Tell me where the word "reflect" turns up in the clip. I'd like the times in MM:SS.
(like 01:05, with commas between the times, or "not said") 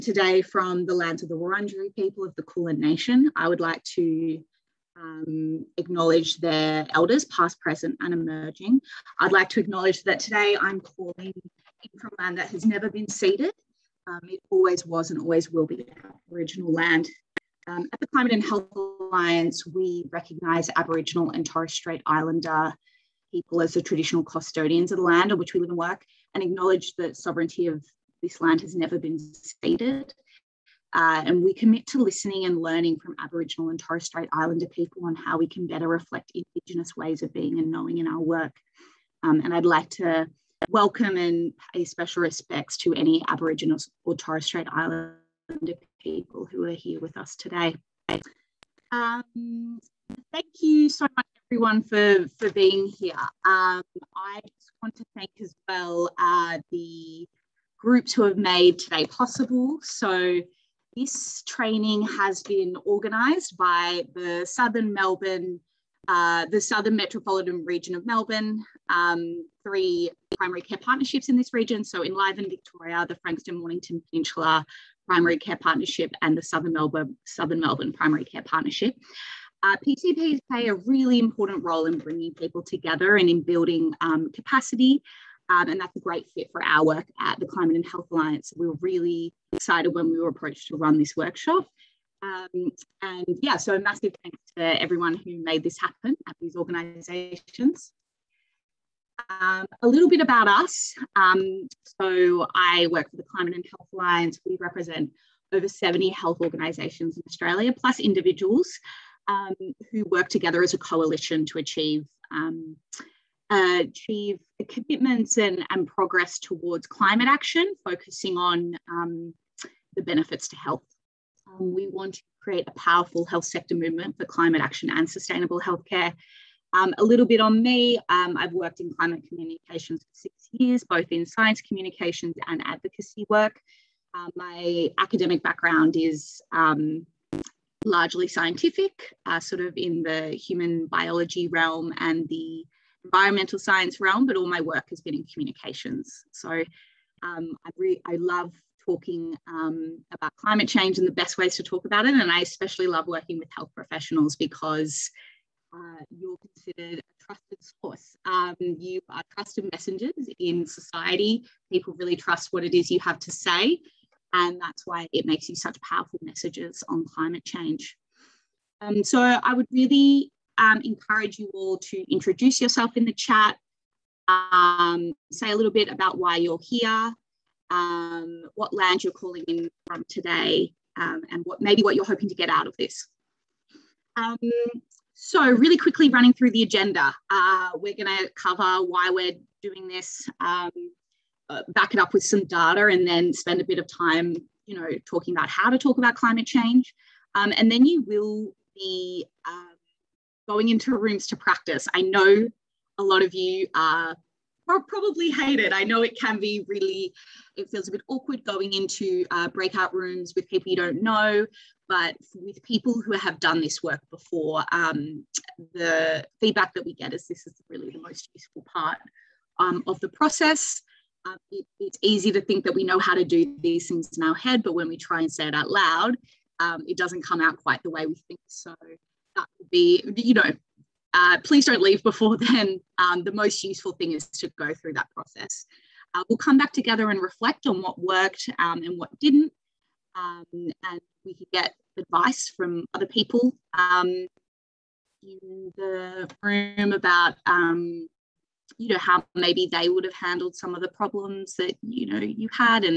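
00:35, 03:57.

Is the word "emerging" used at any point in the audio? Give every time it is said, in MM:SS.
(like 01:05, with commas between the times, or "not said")
00:08.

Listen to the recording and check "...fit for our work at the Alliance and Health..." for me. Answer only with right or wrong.
wrong.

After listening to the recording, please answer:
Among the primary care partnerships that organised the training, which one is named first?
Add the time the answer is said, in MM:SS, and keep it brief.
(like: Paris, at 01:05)
Enliven Victoria, at 01:12.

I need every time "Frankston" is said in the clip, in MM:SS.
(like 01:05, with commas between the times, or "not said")
01:13.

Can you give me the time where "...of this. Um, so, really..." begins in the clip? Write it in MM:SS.
03:02.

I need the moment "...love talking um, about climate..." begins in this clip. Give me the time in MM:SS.
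02:28.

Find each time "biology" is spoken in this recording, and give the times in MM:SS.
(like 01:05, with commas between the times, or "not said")
02:20.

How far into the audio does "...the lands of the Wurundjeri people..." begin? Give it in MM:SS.
00:00.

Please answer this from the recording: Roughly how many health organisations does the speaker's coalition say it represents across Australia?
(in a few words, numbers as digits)
over 70.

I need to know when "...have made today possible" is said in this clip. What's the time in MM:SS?
00:58.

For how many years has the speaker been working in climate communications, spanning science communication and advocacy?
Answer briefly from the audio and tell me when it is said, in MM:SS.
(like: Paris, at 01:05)
6, at 02:10.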